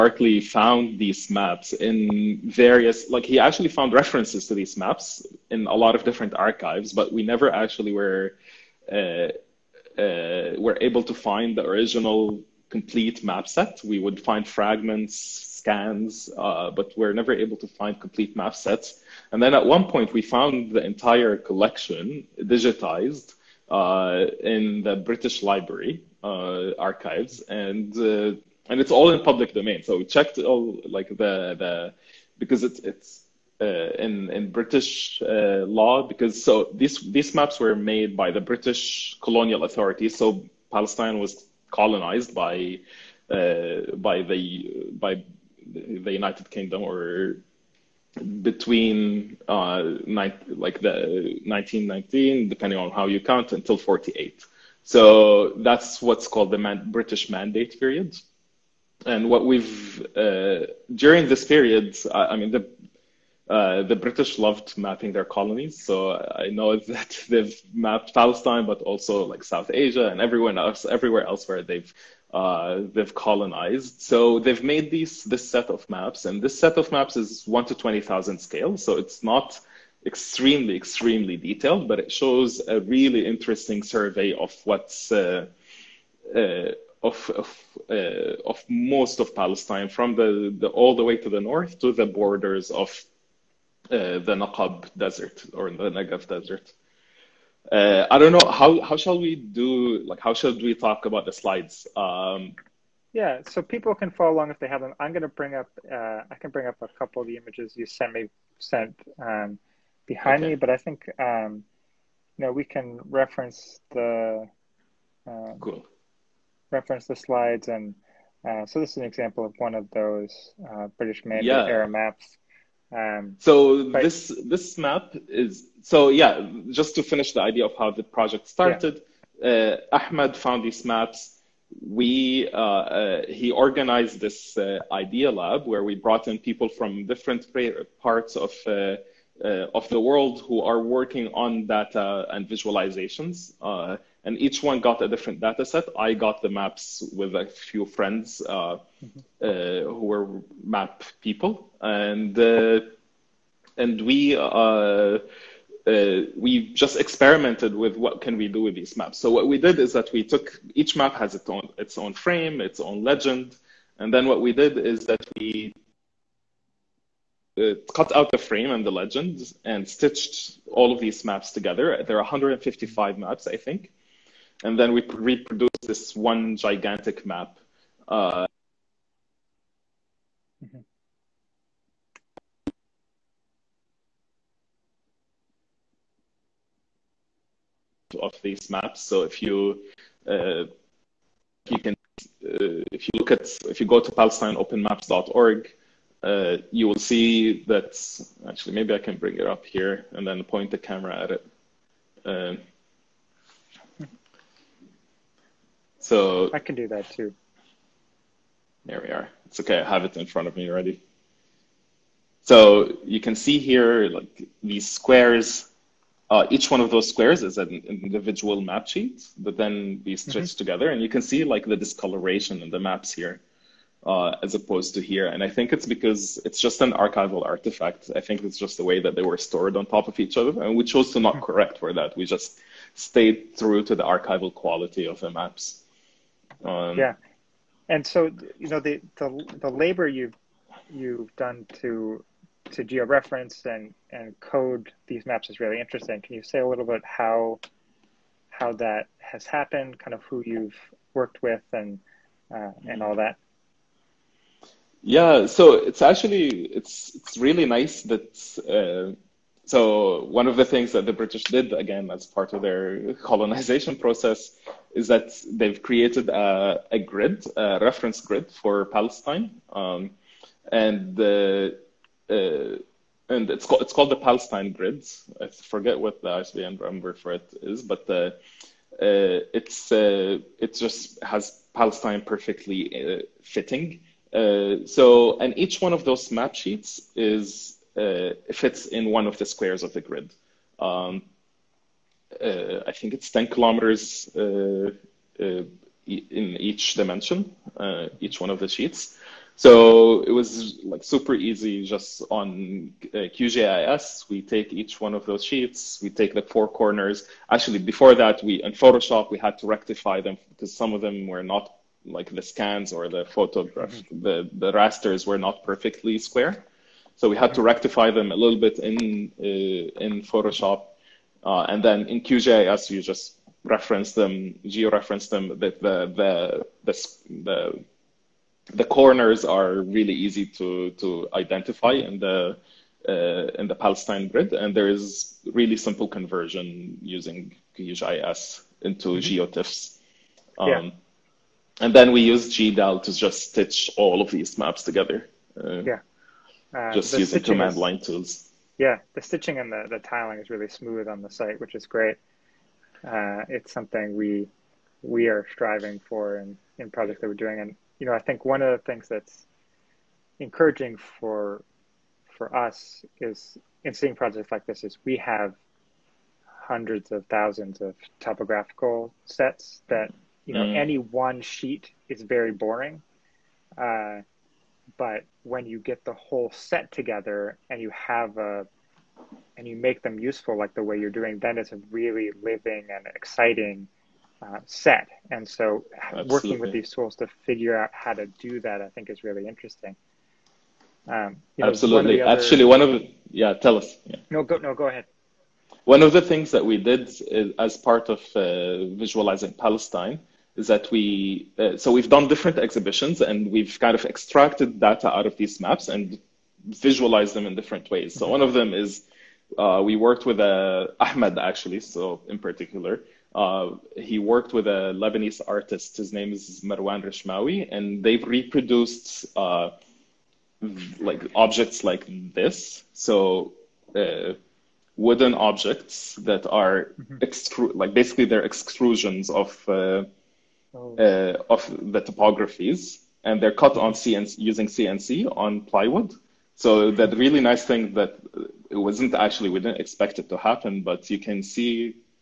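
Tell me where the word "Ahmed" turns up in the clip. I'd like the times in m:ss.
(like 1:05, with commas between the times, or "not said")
2:09, 6:50.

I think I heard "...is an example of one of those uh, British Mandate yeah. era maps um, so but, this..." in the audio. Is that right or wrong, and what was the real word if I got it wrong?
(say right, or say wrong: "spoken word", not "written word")
right.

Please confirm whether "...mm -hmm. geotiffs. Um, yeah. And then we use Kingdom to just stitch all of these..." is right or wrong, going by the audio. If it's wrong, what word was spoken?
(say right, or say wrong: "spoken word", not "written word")
wrong: "GDAL", not "Kingdom".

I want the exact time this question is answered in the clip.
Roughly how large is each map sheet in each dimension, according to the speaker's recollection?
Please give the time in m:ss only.
4:53.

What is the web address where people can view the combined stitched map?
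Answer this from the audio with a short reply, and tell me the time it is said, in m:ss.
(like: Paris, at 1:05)
palestineopenmaps.org, at 3:14.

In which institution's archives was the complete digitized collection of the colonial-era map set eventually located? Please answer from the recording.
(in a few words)
British Library.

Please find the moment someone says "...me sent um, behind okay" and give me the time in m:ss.
1:48.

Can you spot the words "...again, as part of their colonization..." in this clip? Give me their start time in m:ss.
4:21.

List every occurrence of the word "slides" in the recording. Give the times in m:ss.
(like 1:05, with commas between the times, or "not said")
1:41, 1:57.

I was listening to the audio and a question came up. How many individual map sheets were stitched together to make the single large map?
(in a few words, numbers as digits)
155.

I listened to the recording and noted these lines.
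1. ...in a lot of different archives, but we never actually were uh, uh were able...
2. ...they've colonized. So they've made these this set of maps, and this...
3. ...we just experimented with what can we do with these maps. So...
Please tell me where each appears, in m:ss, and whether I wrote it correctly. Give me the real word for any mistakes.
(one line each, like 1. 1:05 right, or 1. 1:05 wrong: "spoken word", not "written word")
1. 0:05 right
2. 1:12 right
3. 2:36 right.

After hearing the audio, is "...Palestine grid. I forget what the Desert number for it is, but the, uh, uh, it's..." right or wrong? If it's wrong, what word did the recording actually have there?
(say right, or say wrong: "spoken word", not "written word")
wrong: "ISBN", not "Desert".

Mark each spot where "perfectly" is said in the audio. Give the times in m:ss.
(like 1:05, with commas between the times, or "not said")
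4:42, 5:15.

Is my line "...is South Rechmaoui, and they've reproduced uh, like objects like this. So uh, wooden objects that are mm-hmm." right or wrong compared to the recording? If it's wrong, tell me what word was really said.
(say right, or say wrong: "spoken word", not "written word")
wrong: "Marwan", not "South".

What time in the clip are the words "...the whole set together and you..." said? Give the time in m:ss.
6:16.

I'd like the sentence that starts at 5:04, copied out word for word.
We take each one of those sheets, we take the four corners.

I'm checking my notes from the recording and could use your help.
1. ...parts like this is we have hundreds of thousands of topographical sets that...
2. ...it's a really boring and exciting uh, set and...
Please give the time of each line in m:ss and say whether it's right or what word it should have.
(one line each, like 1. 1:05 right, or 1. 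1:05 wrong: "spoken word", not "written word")
1. 6:04 wrong: "projects", not "parts"
2. 6:21 wrong: "living", not "boring".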